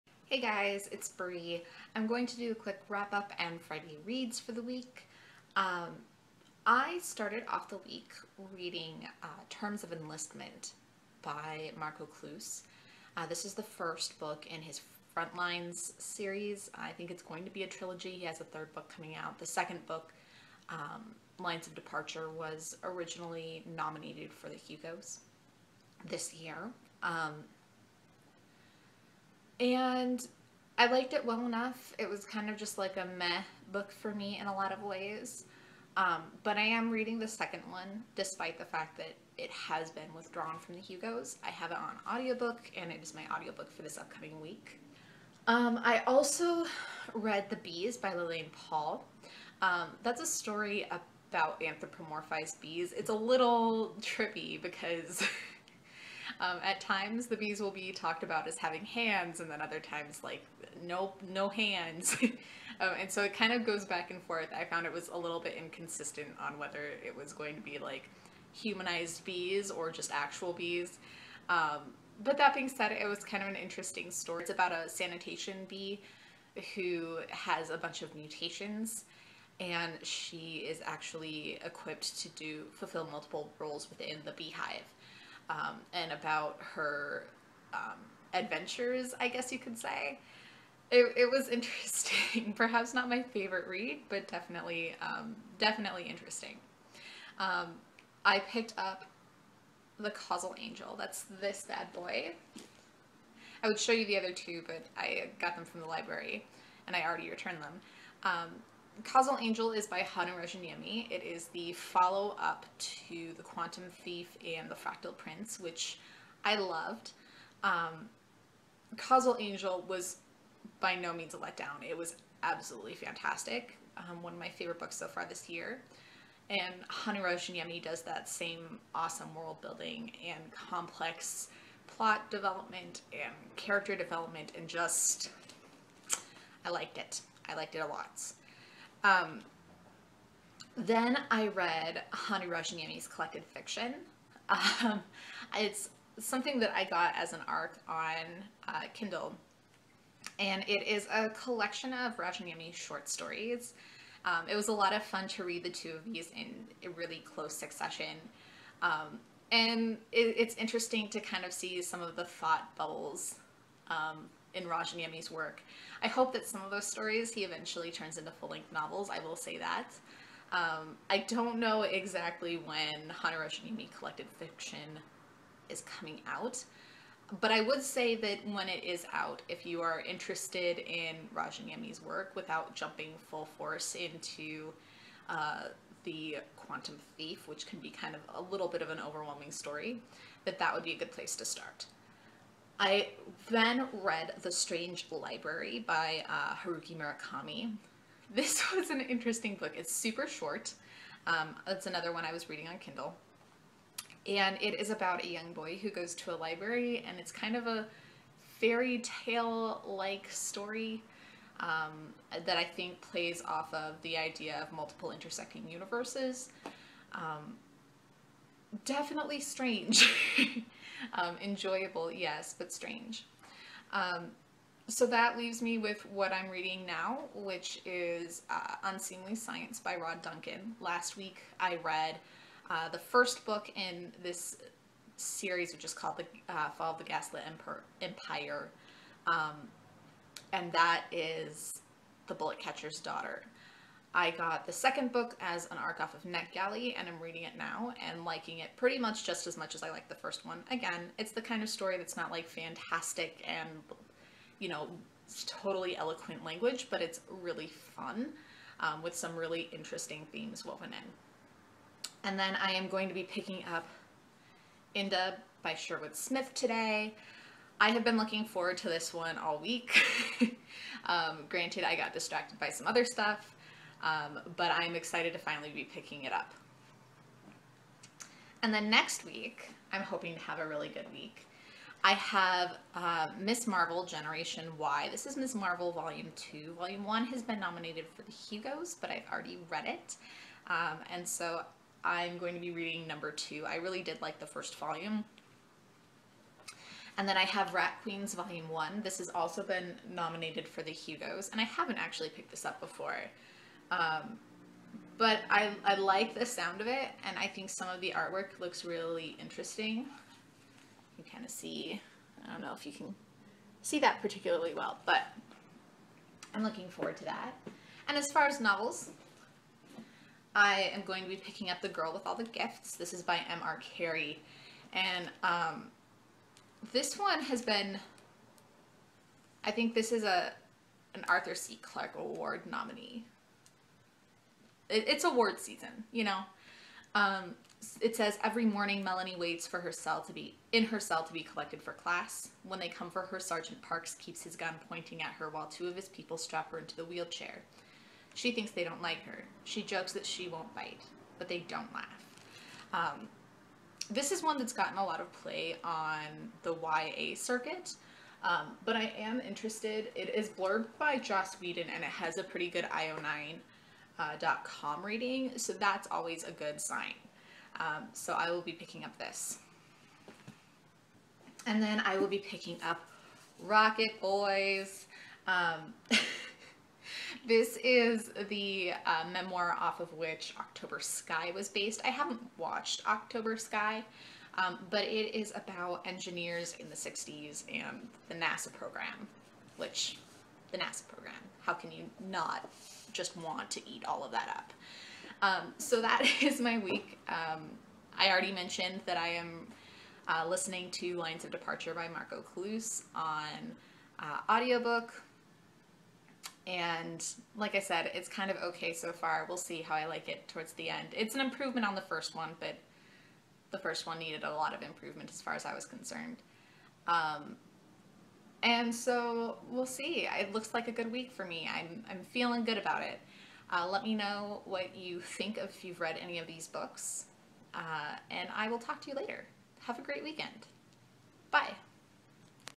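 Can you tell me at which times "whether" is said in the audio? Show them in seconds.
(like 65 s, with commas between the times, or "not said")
66 s.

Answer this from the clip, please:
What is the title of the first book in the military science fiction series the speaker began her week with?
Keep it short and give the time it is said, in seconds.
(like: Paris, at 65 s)
Terms of Enlistment, at 9 s.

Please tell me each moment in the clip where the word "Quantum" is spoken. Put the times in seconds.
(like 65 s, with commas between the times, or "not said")
113 s, 186 s.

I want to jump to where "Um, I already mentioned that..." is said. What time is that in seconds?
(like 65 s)
397 s.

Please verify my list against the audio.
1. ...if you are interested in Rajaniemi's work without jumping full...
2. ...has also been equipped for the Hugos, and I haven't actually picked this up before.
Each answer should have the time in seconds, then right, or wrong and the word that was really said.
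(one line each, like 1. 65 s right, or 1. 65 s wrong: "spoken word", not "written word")
1. 179 s right
2. 299 s wrong: "nominated", not "equipped".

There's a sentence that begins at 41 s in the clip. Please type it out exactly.
I have it on audiobook, and it is my audiobook for this upcoming week.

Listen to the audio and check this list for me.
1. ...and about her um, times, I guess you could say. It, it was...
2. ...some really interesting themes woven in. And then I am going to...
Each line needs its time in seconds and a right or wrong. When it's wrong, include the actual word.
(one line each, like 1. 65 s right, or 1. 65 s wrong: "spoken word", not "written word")
1. 85 s wrong: "adventures", not "times"
2. 259 s right.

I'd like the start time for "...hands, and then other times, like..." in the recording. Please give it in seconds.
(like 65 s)
58 s.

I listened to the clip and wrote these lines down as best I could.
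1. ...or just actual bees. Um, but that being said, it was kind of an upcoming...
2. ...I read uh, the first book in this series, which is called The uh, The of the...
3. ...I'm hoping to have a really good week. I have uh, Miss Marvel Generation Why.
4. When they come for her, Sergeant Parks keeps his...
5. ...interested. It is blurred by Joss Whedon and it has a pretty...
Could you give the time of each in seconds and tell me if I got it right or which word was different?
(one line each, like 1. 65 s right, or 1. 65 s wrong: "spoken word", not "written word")
1. 69 s wrong: "interesting", not "upcoming"
2. 231 s wrong: "Fall", not "The"
3. 279 s right
4. 342 s right
5. 359 s right.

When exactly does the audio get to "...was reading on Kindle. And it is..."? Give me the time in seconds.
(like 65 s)
202 s.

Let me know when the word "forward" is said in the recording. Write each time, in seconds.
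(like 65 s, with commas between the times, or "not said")
268 s, 316 s.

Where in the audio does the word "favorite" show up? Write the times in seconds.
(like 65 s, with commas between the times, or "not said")
93 s, 124 s.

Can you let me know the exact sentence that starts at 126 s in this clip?
And Hannu Rajaniemi does that same awesome world building and complex plot development and character development and just, I liked it.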